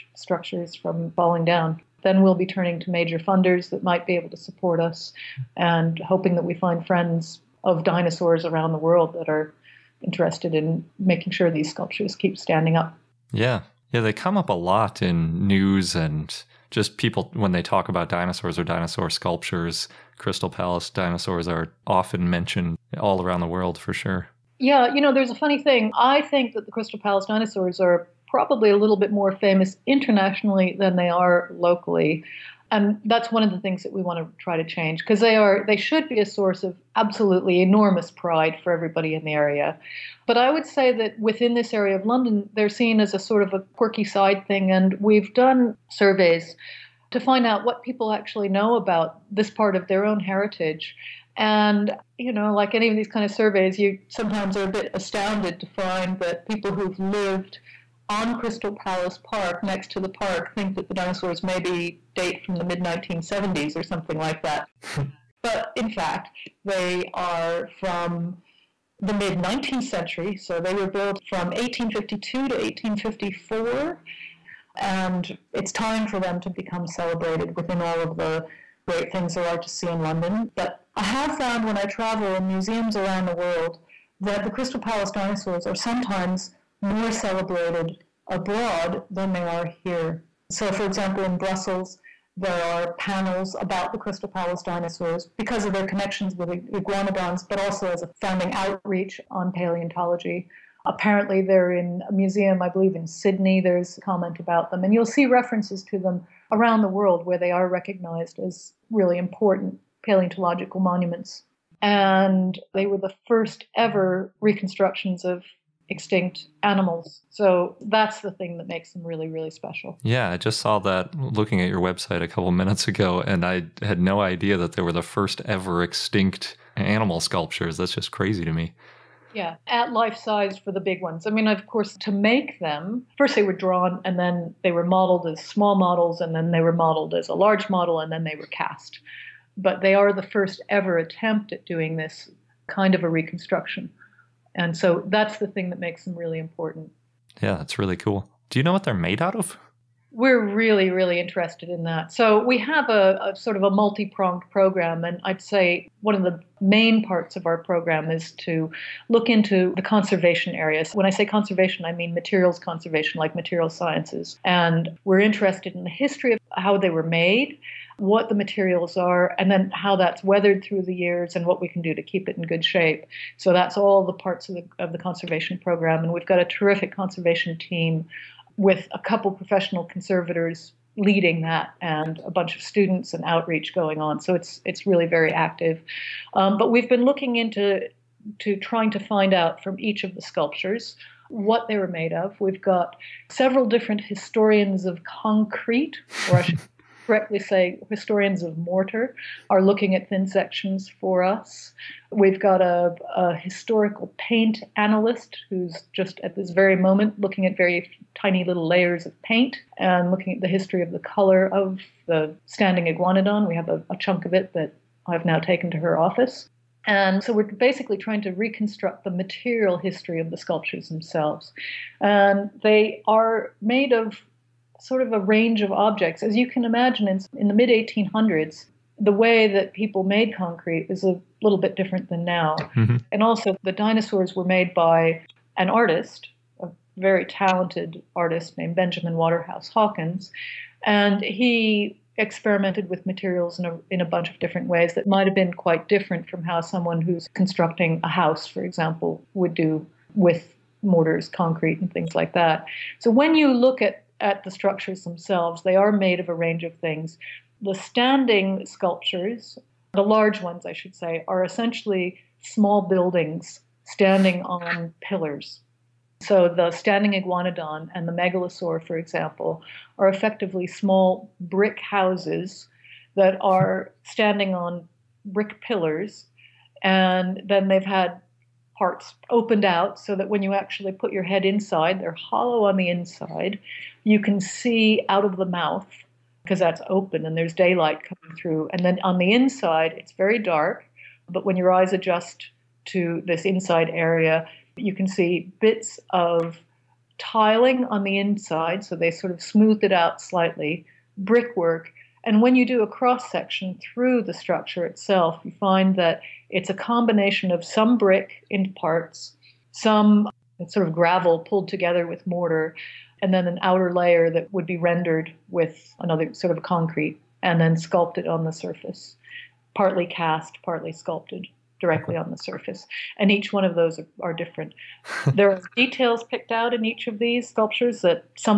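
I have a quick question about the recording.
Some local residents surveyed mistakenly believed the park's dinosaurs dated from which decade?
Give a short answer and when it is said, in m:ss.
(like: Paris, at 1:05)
mid 1970s, at 1:02.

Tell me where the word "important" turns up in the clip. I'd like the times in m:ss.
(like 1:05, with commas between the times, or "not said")
1:49, 2:26.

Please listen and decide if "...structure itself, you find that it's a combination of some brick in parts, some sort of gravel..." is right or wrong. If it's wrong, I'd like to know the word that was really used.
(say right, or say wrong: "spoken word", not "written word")
right.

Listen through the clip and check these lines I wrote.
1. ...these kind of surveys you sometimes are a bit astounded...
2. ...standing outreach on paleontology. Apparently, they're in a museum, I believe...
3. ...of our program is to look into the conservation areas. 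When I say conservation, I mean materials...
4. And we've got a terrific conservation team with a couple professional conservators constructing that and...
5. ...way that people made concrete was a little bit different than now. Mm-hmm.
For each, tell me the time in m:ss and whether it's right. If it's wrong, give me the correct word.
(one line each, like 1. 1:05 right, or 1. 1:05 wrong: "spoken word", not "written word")
1. 0:52 right
2. 1:38 wrong: "founding", not "standing"
3. 2:37 right
4. 2:56 wrong: "leading", not "constructing"
5. 3:49 right.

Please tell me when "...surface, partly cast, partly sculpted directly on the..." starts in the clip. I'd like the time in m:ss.
5:18.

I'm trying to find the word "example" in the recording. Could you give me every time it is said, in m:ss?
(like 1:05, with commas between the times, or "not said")
1:30, 4:08, 4:28.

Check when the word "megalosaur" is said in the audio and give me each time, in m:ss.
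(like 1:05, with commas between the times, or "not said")
4:28.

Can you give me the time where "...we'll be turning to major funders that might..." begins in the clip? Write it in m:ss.
0:02.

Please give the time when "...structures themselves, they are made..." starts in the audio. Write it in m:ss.
4:14.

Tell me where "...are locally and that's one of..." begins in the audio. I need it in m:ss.
0:31.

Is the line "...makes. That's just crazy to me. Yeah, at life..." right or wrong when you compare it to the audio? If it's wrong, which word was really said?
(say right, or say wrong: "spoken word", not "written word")
wrong: "sculptures", not "makes".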